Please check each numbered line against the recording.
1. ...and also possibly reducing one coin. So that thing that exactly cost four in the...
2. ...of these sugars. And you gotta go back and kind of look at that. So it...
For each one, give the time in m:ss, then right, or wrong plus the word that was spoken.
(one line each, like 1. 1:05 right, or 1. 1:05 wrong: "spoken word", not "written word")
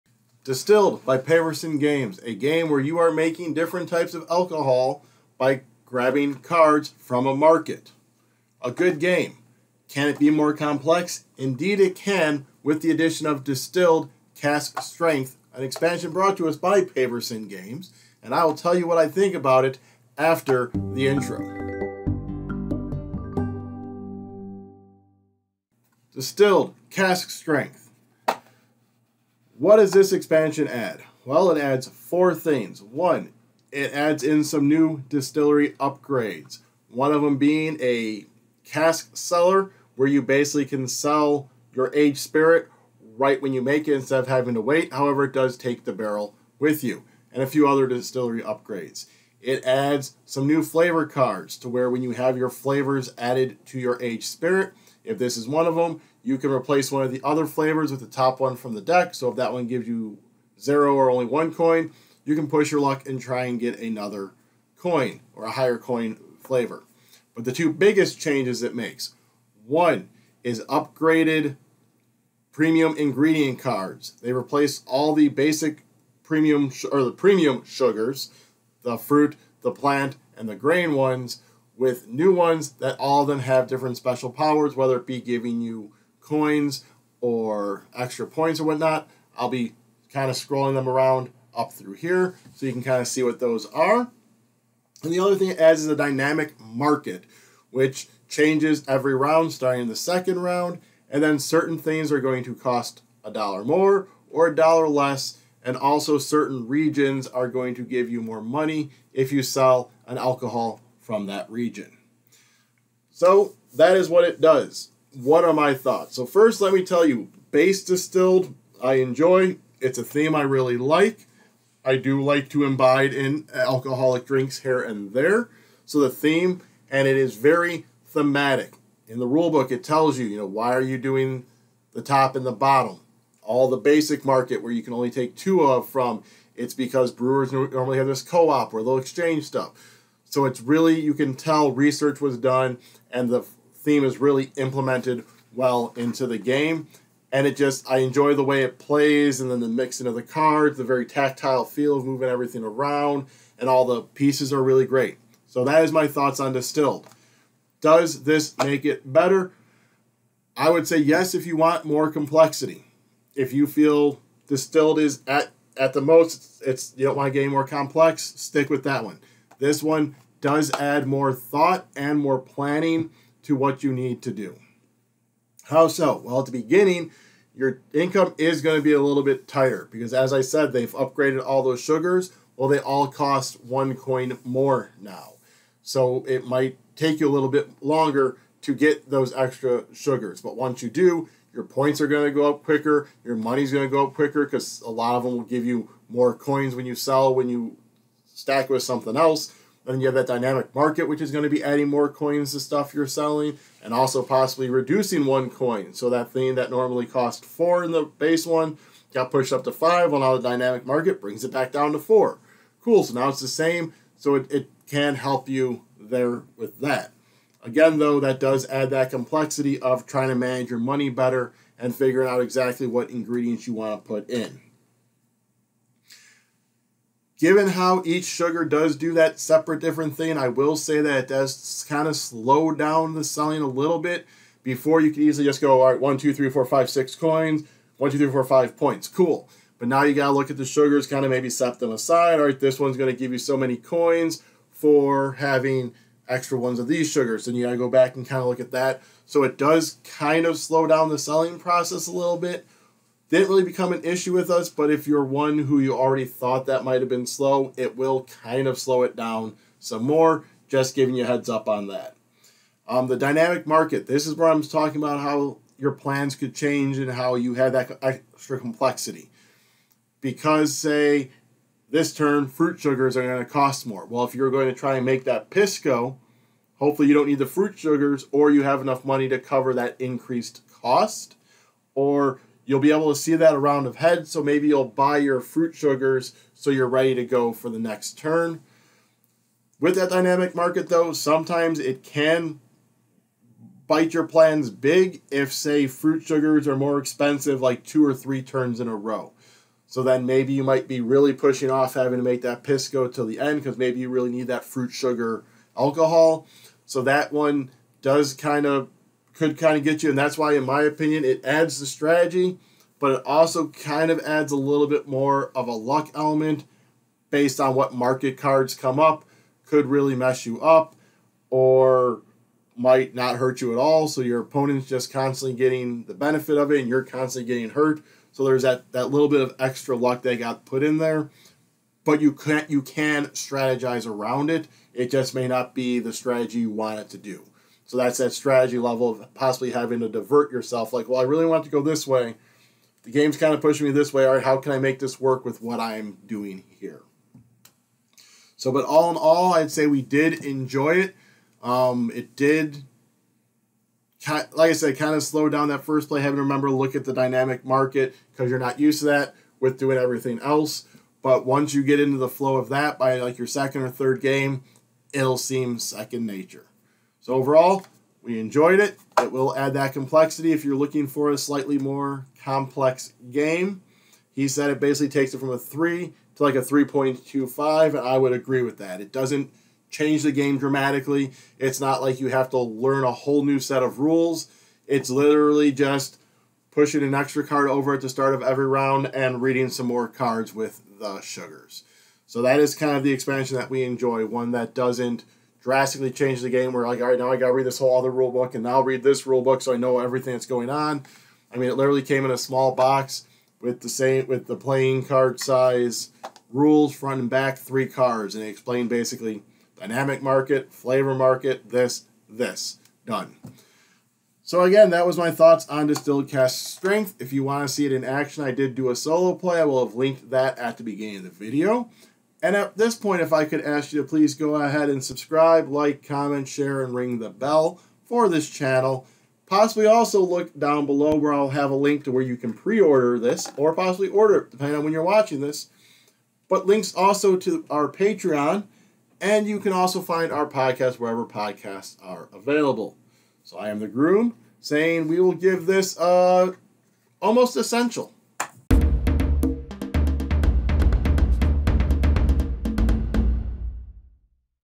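1. 3:23 wrong: "normally", not "exactly"
2. 4:06 right.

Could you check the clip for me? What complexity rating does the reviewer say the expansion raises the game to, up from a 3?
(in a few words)
3.25.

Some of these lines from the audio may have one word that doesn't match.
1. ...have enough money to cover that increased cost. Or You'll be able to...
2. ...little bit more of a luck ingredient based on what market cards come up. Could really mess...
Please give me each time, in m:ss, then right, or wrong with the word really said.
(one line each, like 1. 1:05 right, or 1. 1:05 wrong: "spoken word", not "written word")
1. 4:38 right
2. 5:14 wrong: "element", not "ingredient".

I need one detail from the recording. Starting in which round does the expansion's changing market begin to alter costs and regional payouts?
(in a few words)
Second round.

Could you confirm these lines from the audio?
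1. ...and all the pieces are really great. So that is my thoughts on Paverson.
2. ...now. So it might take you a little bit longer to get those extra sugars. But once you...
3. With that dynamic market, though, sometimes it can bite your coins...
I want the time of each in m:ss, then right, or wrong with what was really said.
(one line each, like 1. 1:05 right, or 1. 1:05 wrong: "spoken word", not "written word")
1. 2:33 wrong: "Distilled", not "Paverson"
2. 3:04 right
3. 4:49 wrong: "plans", not "coins".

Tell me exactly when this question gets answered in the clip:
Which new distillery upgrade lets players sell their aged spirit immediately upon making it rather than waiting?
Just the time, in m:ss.
0:38.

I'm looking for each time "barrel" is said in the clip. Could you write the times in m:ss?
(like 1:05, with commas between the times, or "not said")
0:45.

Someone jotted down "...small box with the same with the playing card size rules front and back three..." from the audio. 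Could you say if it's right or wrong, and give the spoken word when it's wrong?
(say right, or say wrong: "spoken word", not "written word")
right.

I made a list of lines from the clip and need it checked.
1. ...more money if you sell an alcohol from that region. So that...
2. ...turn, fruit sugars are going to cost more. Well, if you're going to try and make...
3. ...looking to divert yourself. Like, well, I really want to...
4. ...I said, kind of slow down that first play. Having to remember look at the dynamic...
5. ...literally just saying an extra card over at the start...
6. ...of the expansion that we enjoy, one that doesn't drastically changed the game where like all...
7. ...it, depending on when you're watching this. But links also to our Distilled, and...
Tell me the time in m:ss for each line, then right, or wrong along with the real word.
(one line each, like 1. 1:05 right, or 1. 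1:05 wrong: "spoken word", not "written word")
1. 1:48 right
2. 4:32 right
3. 5:39 wrong: "having", not "looking"
4. 5:54 right
5. 6:25 wrong: "pushing", not "saying"
6. 6:32 right
7. 7:14 wrong: "Patreon", not "Distilled".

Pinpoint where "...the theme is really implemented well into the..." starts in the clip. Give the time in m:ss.
2:23.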